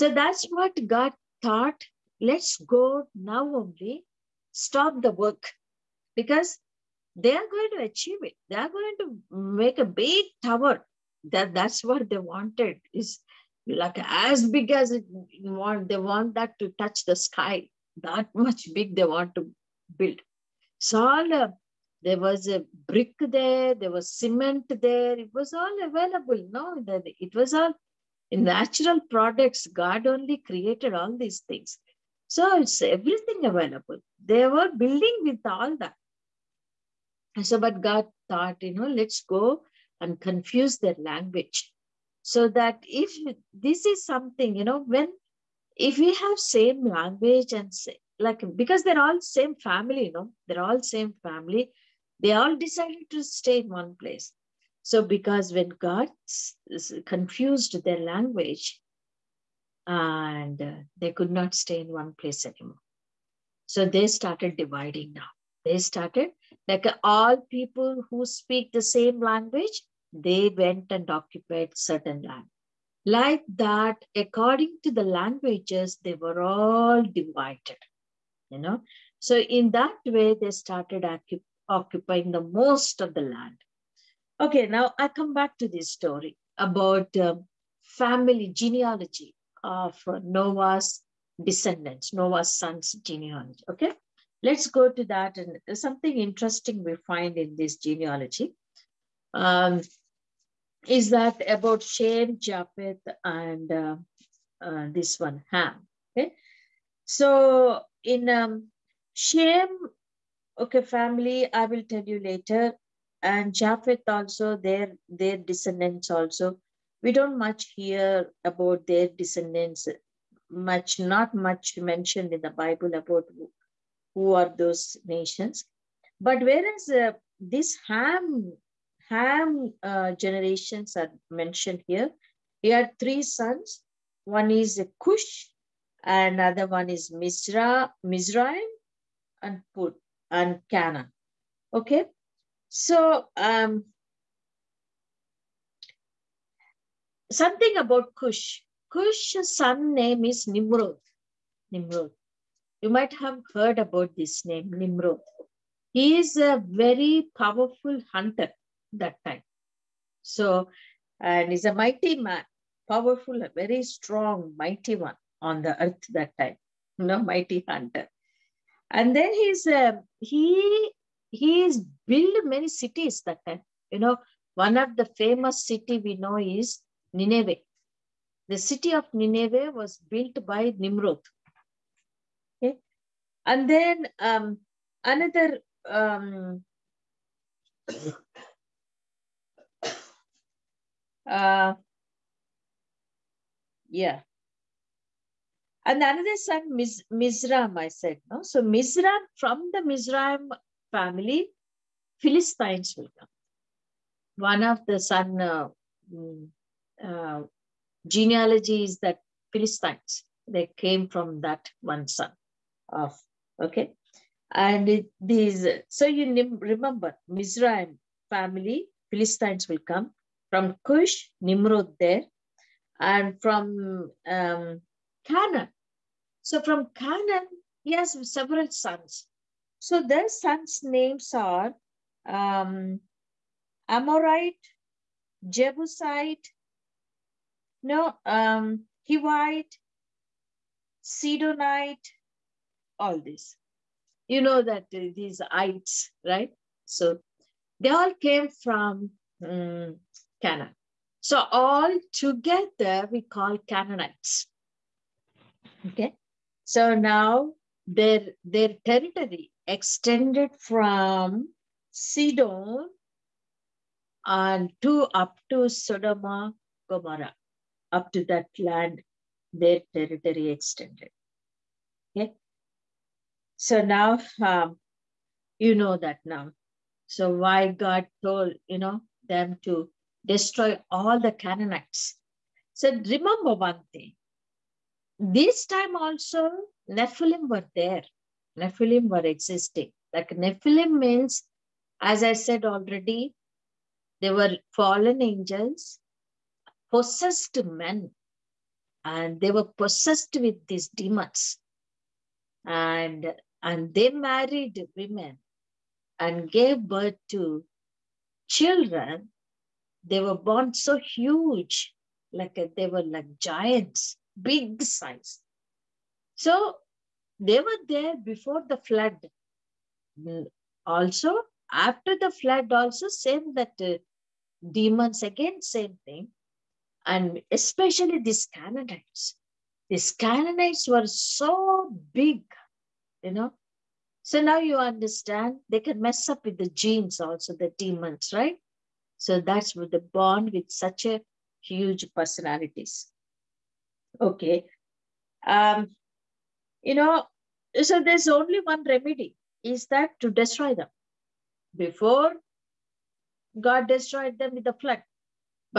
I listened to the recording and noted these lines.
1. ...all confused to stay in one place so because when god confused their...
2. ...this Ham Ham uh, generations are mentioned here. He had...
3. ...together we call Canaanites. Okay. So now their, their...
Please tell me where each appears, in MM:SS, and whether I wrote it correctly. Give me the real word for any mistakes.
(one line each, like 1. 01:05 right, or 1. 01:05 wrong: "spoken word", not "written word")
1. 00:52 wrong: "decided", not "confused"
2. 02:07 right
3. 04:12 right.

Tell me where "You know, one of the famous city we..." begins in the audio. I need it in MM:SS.
02:53.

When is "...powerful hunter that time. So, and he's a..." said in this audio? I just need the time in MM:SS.
02:37.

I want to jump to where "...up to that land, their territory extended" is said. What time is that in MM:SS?
04:27.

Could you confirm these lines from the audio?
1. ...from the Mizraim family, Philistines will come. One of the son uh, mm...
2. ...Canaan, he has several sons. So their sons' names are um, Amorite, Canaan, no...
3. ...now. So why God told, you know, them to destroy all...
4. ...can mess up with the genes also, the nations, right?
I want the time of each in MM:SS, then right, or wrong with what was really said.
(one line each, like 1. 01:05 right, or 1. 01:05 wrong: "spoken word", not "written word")
1. 03:19 right
2. 03:46 wrong: "Jebusite", not "Canaan"
3. 04:36 right
4. 05:35 wrong: "demons", not "nations".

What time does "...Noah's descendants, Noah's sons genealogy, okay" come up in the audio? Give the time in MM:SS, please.
01:30.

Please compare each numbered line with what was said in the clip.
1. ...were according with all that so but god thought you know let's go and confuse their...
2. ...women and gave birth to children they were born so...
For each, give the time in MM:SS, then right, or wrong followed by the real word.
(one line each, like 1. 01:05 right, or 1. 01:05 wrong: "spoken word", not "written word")
1. 00:34 wrong: "building", not "according"
2. 05:04 right.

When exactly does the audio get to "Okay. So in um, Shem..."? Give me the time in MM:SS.
01:46.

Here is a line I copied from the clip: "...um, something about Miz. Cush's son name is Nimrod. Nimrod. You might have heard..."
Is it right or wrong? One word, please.
wrong.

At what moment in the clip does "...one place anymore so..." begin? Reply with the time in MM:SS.
01:01.